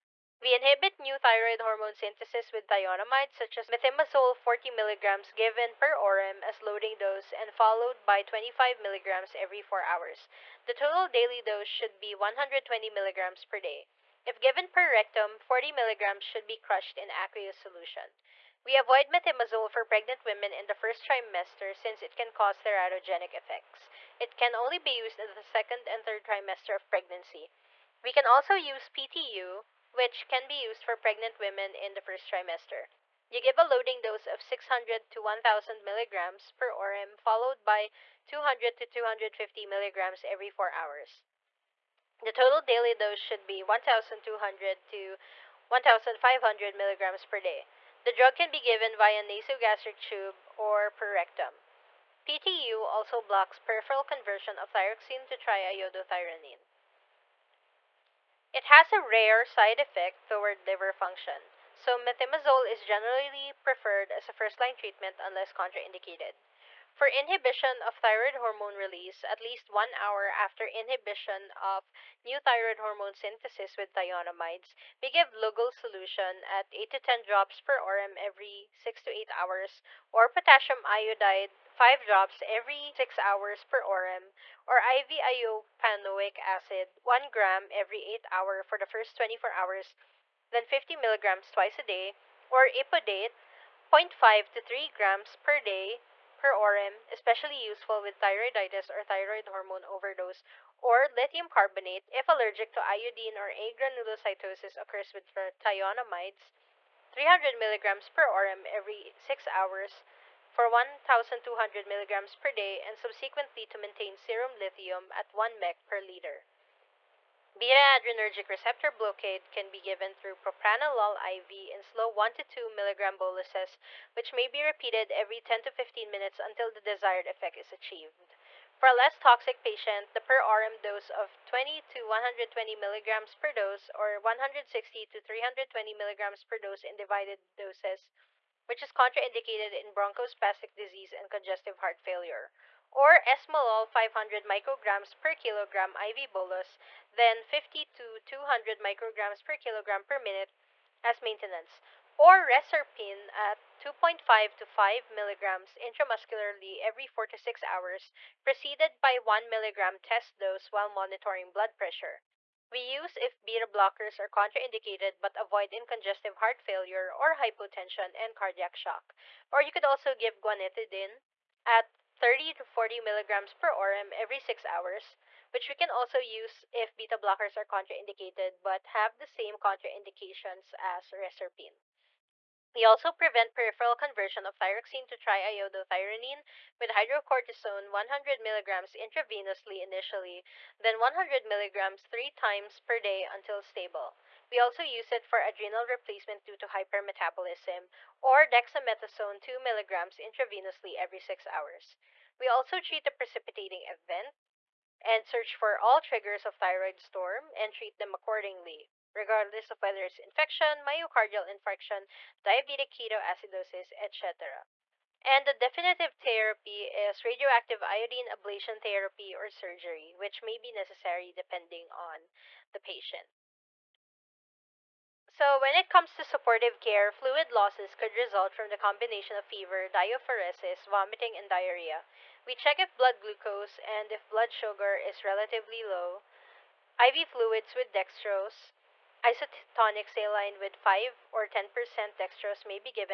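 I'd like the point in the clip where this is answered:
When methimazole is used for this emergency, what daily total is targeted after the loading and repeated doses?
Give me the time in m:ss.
0:12.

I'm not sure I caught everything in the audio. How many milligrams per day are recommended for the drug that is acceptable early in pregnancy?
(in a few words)
1200 to 1500 mg.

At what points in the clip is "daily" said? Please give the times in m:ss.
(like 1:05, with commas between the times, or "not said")
0:11, 0:42.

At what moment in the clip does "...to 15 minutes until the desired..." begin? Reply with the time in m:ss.
2:05.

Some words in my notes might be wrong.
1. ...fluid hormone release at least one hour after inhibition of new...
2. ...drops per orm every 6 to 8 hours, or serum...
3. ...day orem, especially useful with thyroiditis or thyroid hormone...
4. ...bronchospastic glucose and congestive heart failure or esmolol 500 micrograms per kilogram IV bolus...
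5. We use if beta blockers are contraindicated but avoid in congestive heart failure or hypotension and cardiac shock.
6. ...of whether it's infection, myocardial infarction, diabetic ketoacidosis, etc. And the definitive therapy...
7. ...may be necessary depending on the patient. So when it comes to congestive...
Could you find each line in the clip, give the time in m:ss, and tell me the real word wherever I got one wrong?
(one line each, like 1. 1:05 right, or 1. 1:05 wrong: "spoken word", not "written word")
1. 1:07 wrong: "thyroid", not "fluid"
2. 1:17 wrong: "potassium", not "serum"
3. 1:35 right
4. 2:19 wrong: "disease", not "glucose"
5. 2:42 right
6. 3:29 right
7. 3:40 wrong: "supportive", not "congestive".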